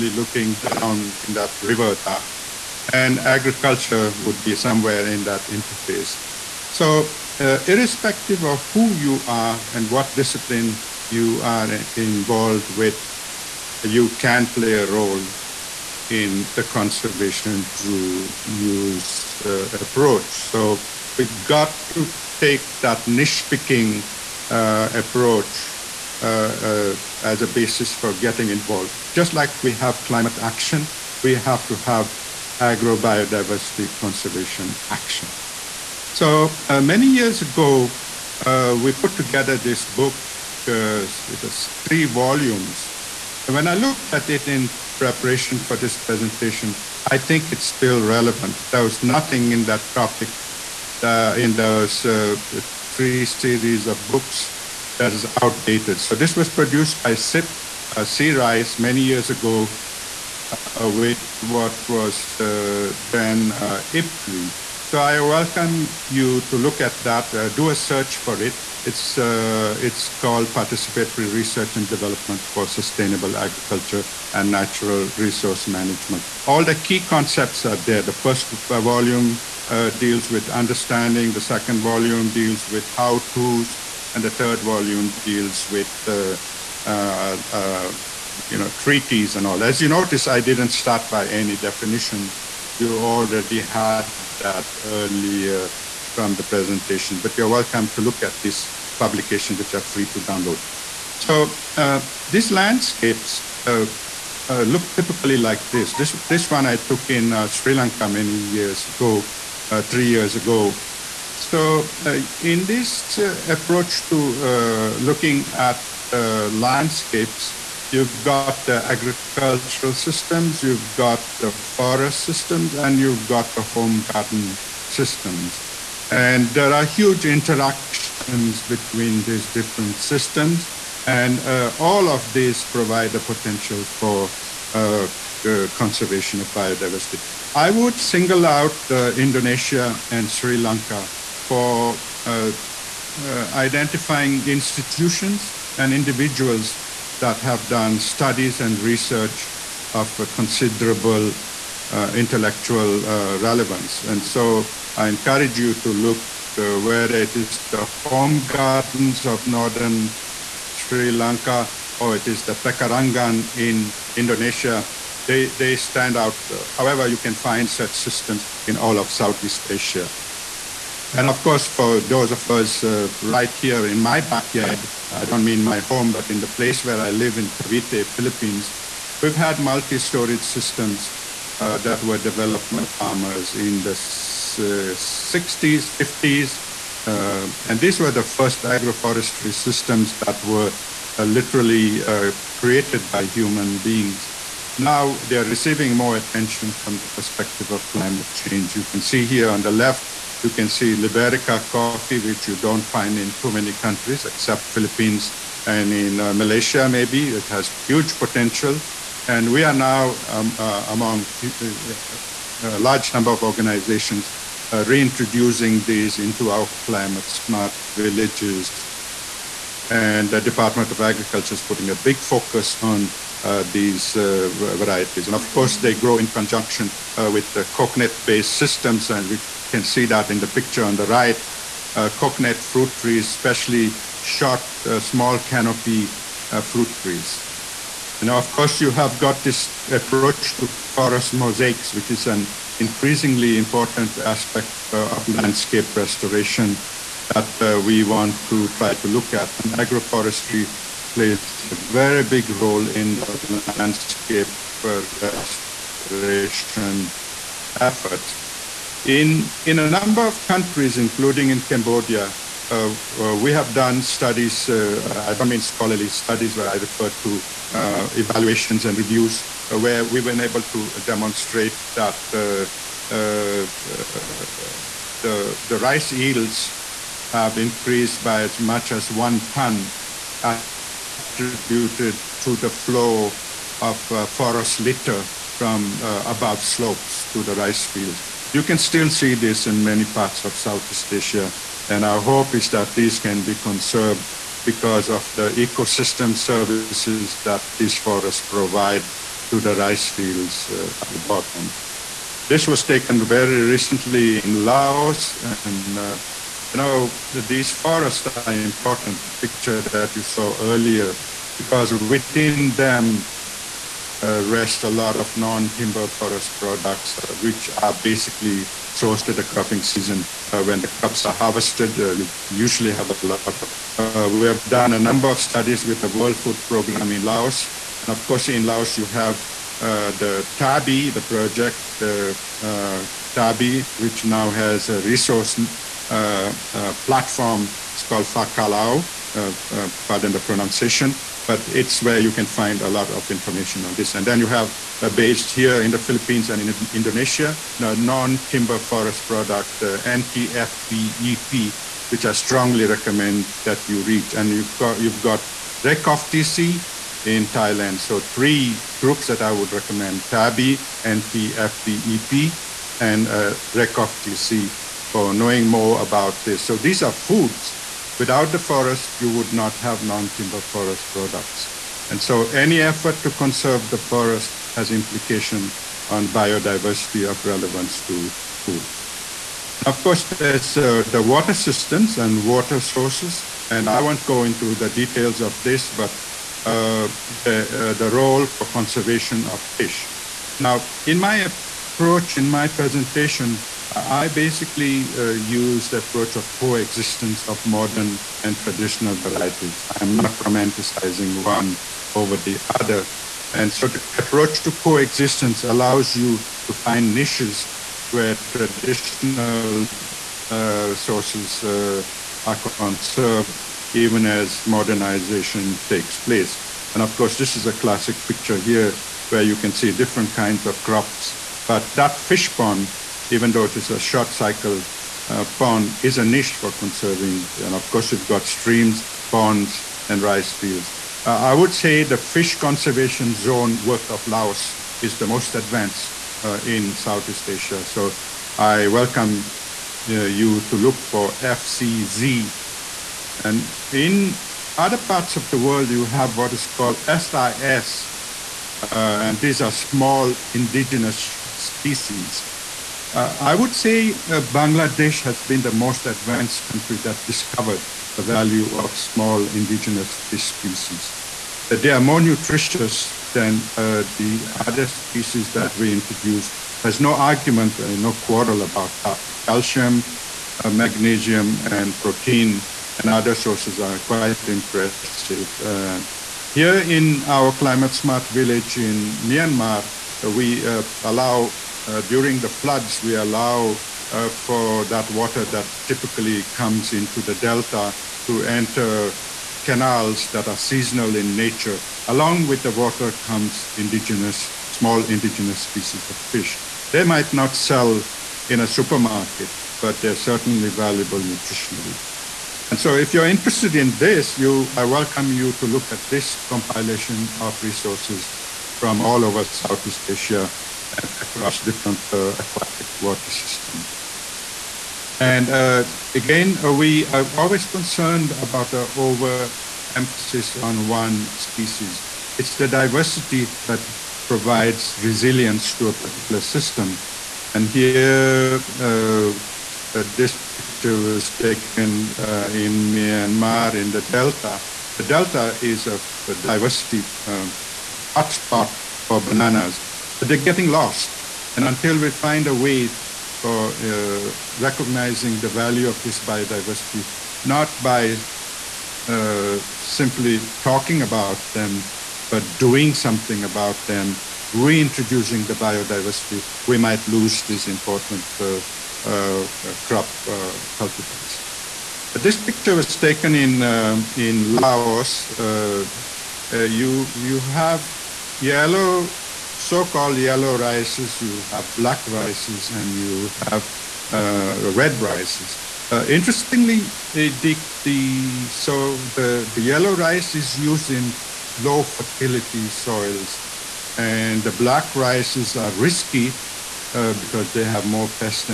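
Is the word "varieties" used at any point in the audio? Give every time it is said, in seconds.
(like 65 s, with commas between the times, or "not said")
224 s, 399 s.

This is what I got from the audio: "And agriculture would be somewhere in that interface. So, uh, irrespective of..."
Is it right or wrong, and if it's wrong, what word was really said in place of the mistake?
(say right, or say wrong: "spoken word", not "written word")
right.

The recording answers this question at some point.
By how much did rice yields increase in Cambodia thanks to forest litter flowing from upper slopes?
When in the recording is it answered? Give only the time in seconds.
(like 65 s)
279 s.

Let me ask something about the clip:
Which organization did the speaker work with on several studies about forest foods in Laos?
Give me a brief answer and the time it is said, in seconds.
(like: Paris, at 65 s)
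World Food Program, at 326 s.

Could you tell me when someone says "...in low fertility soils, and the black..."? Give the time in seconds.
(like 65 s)
580 s.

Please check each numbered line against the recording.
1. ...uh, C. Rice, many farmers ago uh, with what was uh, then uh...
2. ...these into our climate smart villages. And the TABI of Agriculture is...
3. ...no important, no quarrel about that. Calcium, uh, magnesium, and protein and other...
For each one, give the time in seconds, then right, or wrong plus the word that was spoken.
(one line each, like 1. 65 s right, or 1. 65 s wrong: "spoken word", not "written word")
1. 57 s wrong: "years", not "farmers"
2. 215 s wrong: "Department", not "TABI"
3. 467 s wrong: "argument", not "important".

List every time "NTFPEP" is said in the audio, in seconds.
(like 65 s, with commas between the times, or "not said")
350 s, 361 s.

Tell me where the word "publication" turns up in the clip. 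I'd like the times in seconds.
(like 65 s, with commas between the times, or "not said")
98 s.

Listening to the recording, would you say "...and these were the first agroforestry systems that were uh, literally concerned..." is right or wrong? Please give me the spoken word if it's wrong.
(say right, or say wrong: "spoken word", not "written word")
wrong: "created", not "concerned".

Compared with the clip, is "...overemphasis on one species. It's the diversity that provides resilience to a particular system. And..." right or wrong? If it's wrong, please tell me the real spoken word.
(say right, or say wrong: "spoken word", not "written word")
right.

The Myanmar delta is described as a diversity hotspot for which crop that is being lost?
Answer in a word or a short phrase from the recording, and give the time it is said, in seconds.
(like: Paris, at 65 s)
Bananas, at 539 s.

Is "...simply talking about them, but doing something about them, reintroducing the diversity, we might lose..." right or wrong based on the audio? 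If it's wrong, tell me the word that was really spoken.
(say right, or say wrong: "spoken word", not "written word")
wrong: "biodiversity", not "diversity".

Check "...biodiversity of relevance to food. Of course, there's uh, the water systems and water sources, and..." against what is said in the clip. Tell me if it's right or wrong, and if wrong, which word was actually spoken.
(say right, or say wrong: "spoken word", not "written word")
right.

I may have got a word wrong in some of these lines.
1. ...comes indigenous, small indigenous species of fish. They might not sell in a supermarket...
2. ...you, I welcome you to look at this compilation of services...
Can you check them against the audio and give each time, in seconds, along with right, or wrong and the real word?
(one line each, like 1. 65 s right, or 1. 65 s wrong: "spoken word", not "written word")
1. 493 s right
2. 504 s wrong: "resources", not "services".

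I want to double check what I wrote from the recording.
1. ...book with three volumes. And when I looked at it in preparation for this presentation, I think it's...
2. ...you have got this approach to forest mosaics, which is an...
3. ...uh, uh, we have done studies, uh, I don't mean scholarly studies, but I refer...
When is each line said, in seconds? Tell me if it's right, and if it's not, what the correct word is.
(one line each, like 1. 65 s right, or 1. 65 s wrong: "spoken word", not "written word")
1. 39 s right
2. 238 s right
3. 262 s right.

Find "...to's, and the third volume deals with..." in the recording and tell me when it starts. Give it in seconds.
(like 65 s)
83 s.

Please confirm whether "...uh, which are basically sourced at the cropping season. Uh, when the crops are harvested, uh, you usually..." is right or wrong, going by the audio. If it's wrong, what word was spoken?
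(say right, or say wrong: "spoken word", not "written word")
right.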